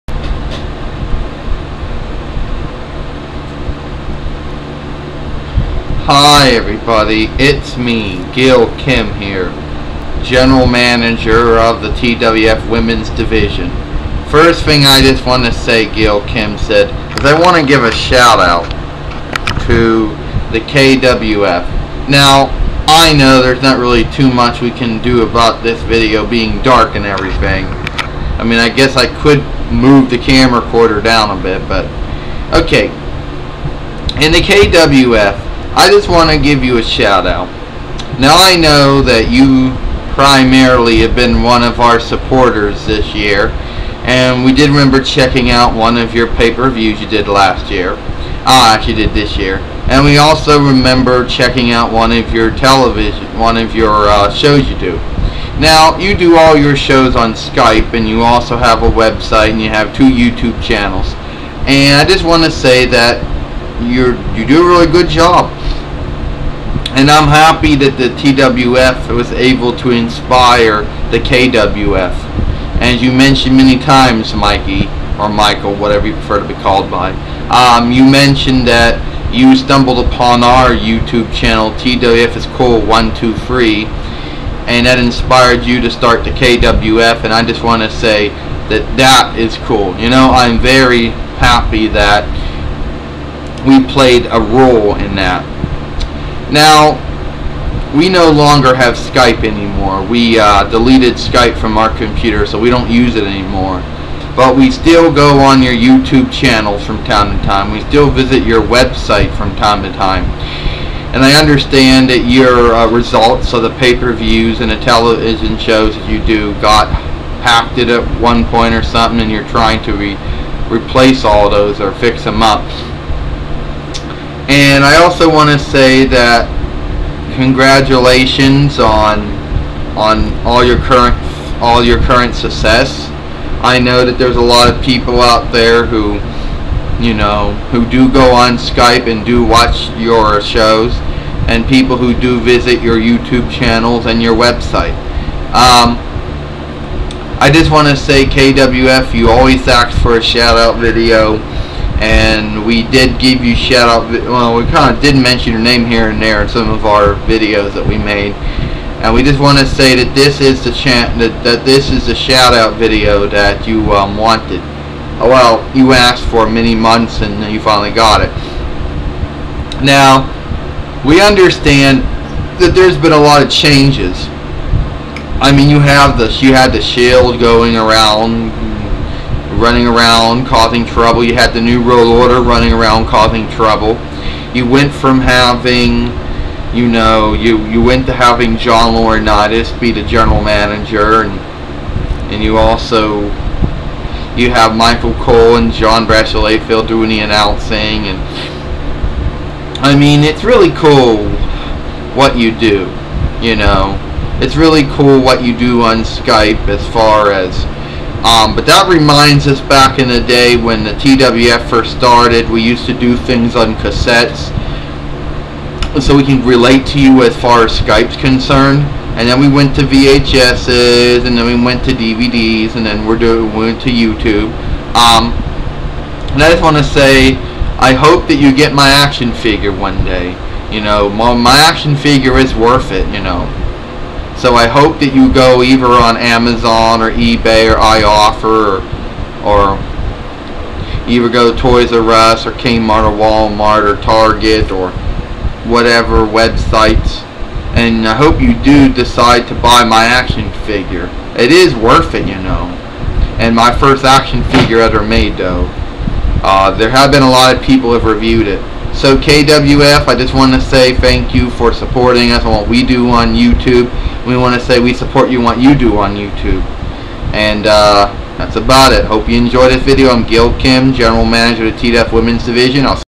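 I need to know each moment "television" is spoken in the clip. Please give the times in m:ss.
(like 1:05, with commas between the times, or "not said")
0:52, 1:54.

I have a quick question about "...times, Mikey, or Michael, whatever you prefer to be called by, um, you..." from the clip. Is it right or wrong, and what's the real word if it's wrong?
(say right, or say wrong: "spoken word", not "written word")
right.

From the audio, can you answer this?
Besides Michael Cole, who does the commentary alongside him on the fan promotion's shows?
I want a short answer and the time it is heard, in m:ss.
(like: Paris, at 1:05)
John Bradshaw Layfield, at 3:15.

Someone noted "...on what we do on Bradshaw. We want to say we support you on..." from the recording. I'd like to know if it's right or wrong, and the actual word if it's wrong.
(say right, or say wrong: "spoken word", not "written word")
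wrong: "YouTube", not "Bradshaw".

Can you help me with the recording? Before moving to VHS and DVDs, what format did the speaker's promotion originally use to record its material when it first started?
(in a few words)
cassettes.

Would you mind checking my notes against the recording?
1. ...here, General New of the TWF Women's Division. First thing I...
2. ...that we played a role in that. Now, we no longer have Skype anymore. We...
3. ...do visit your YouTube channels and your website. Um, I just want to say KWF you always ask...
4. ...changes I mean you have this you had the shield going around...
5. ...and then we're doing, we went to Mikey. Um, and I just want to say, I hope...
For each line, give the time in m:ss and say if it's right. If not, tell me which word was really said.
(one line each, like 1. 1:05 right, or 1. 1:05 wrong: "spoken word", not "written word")
1. 0:09 wrong: "Manager", not "New"
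2. 1:31 right
3. 2:22 right
4. 2:53 right
5. 3:42 wrong: "YouTube", not "Mikey".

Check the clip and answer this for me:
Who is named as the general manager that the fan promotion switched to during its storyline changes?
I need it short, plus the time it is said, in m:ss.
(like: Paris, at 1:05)
John Laurinaitis, at 3:08.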